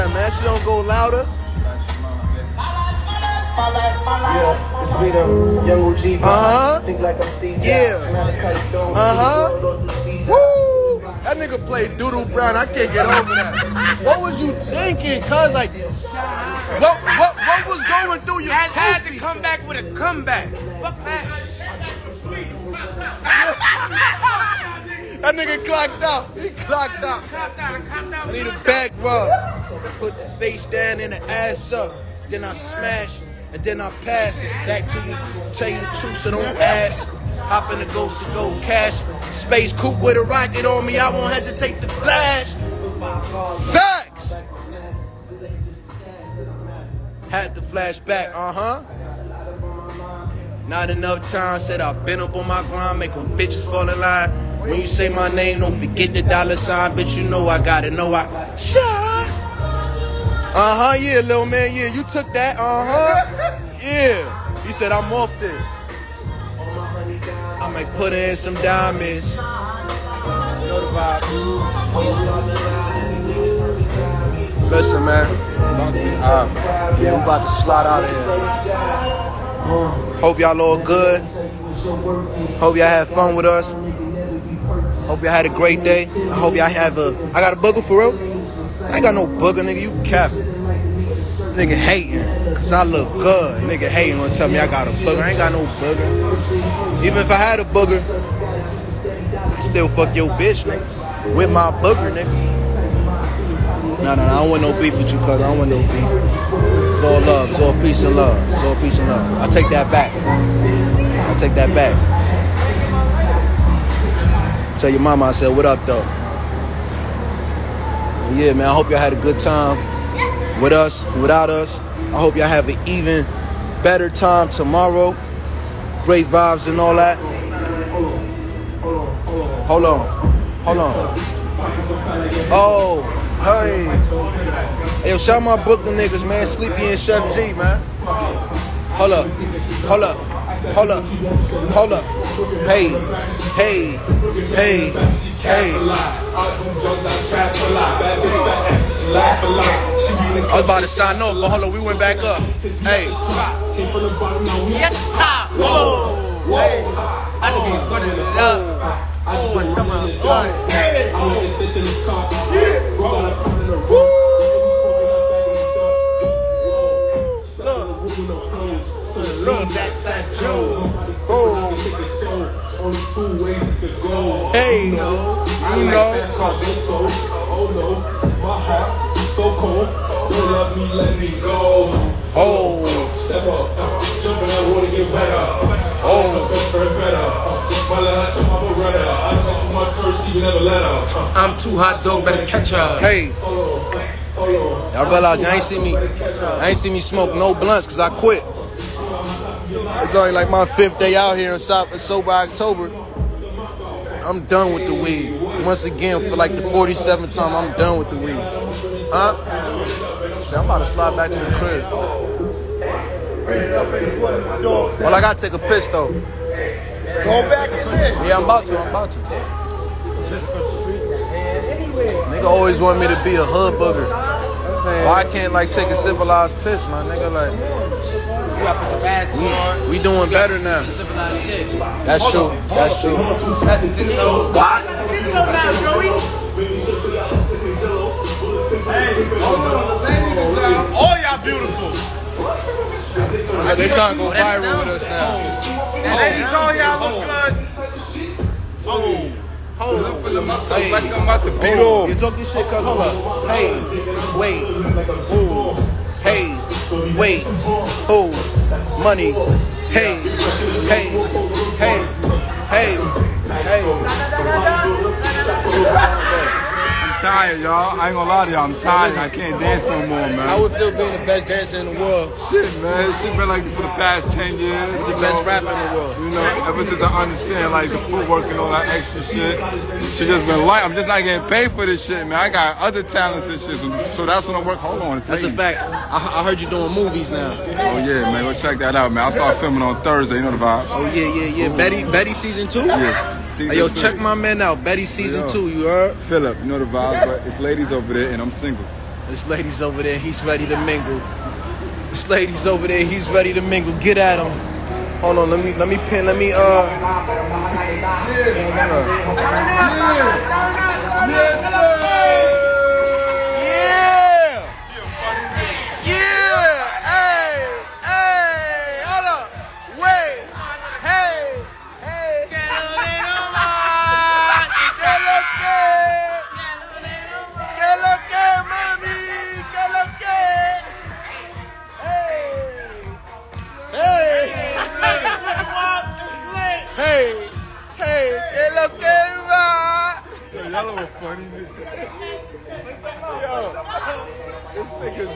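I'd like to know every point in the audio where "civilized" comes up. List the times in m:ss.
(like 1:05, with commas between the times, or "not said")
3:45, 3:50.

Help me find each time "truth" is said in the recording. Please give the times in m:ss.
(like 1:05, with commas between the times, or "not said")
0:36.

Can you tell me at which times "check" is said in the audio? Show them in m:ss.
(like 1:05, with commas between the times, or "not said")
4:48, 4:53.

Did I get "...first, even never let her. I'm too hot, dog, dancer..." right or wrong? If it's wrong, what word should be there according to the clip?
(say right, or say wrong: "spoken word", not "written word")
wrong: "better", not "dancer".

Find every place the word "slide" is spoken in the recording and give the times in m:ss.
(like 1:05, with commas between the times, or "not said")
1:17, 3:30.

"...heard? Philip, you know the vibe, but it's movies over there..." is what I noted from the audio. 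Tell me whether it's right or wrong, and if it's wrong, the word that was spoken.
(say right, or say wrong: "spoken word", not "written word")
wrong: "ladies", not "movies".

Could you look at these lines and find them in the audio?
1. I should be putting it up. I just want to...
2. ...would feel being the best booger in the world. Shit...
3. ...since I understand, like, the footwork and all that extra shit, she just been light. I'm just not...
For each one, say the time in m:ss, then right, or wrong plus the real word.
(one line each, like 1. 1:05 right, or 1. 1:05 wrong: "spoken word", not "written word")
1. 2:37 right
2. 4:30 wrong: "dancer", not "booger"
3. 4:36 right.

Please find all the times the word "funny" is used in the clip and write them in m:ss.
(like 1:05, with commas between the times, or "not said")
5:41.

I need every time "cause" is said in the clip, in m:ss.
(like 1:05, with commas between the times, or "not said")
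1:32, 3:17, 4:12.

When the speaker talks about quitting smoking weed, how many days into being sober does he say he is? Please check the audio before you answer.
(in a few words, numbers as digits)
5.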